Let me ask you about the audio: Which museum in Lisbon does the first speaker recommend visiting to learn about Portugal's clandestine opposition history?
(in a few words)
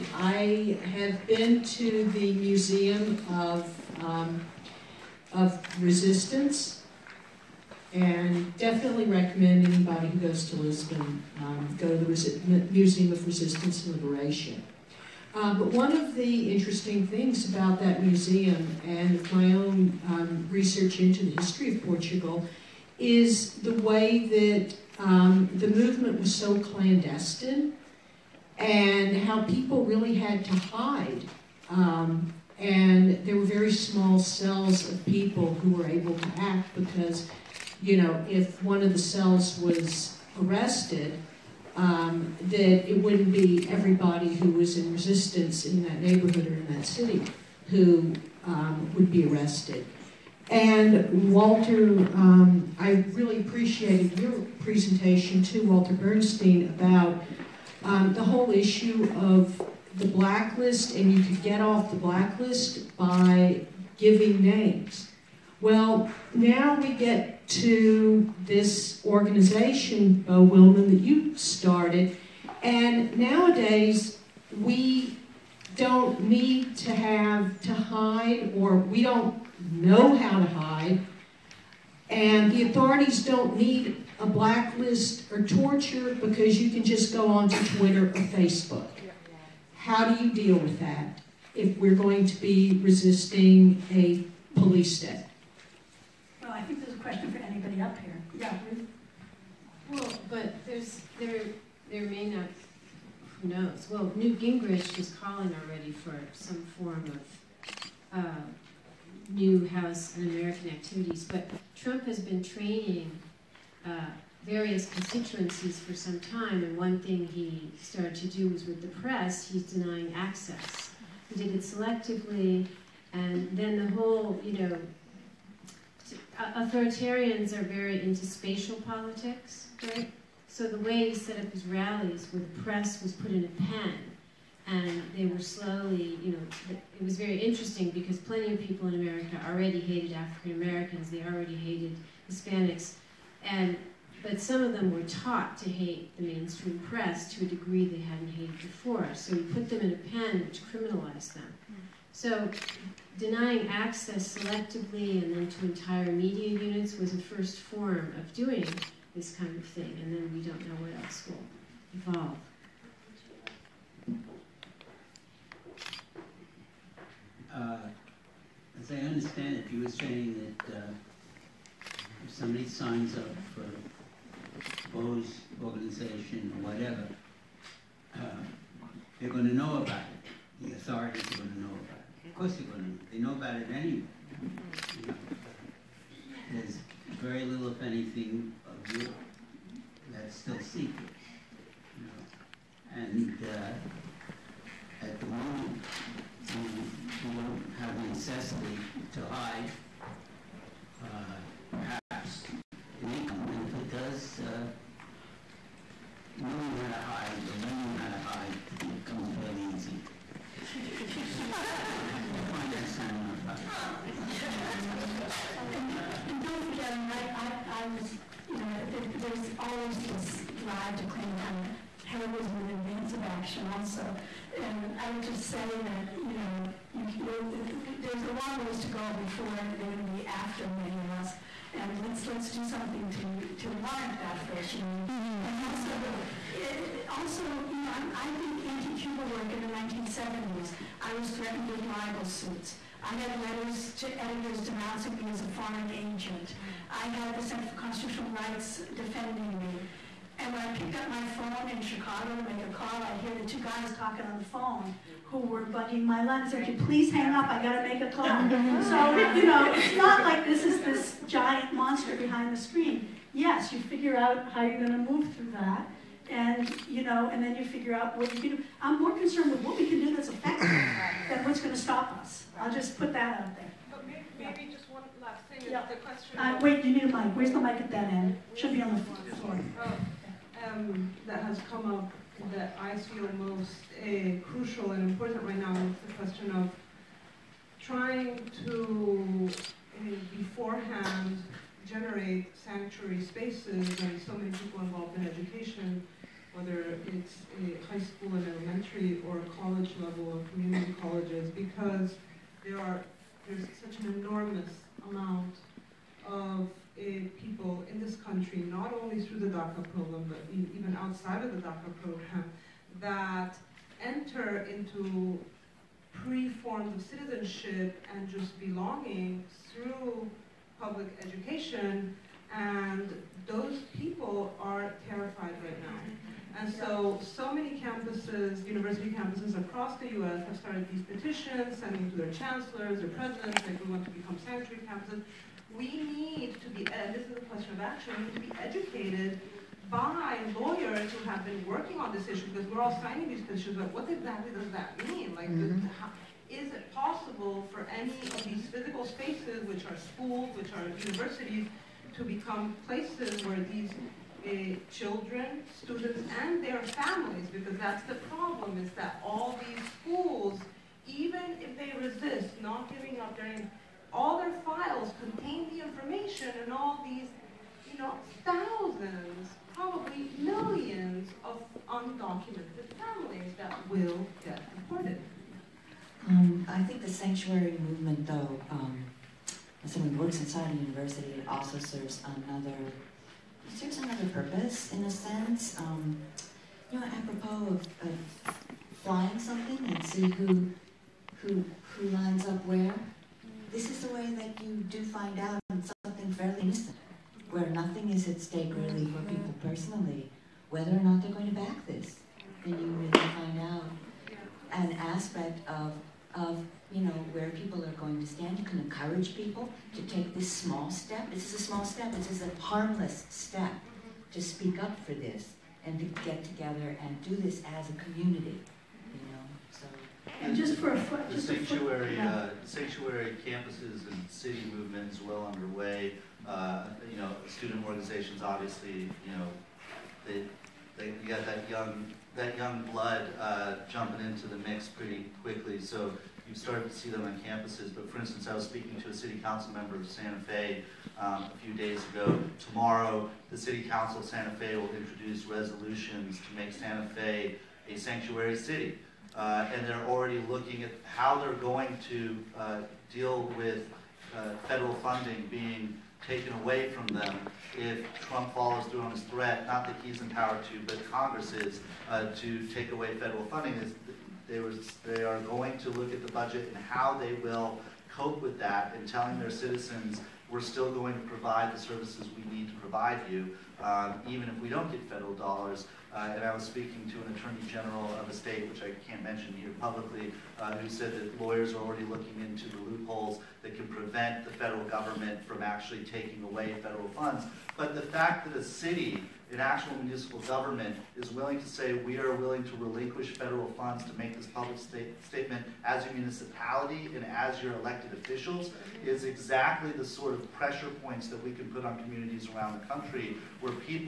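Museum of Resistance and Liberation.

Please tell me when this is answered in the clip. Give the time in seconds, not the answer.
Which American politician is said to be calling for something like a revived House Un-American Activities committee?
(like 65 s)
104 s.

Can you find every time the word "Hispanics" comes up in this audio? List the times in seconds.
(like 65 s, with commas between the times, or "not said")
142 s.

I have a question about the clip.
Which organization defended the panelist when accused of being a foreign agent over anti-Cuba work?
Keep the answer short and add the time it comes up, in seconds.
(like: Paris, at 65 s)
Center for Constitutional Rights, at 247 s.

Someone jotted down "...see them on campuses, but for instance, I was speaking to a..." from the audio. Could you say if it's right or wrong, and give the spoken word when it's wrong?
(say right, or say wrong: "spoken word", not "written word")
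right.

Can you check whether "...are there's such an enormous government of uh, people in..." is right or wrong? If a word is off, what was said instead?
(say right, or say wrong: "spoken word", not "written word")
wrong: "amount", not "government".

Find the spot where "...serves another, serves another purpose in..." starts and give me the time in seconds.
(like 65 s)
381 s.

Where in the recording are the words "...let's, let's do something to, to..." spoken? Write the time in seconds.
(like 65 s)
232 s.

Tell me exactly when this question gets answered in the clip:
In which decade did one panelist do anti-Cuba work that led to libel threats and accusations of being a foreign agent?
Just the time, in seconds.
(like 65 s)
239 s.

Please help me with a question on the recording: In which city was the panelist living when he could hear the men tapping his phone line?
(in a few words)
Chicago.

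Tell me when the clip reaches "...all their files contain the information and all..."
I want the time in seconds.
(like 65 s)
364 s.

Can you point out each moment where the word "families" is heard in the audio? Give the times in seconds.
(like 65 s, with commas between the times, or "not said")
357 s, 372 s.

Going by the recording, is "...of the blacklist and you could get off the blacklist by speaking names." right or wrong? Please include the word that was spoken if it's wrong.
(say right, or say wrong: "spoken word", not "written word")
wrong: "giving", not "speaking".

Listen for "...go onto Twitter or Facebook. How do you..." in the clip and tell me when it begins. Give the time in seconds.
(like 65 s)
87 s.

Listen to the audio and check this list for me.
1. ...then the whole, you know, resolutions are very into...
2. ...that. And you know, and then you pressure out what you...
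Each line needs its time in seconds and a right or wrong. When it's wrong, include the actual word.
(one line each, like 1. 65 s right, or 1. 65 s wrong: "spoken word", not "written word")
1. 123 s wrong: "authoritarians", not "resolutions"
2. 265 s wrong: "figure", not "pressure".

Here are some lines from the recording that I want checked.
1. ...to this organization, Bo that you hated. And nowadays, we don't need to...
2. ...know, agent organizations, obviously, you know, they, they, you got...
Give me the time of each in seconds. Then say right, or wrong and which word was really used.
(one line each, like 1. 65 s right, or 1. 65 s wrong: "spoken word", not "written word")
1. 67 s wrong: "started", not "hated"
2. 427 s wrong: "student", not "agent".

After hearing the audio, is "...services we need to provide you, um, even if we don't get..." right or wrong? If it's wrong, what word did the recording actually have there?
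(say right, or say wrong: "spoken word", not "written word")
right.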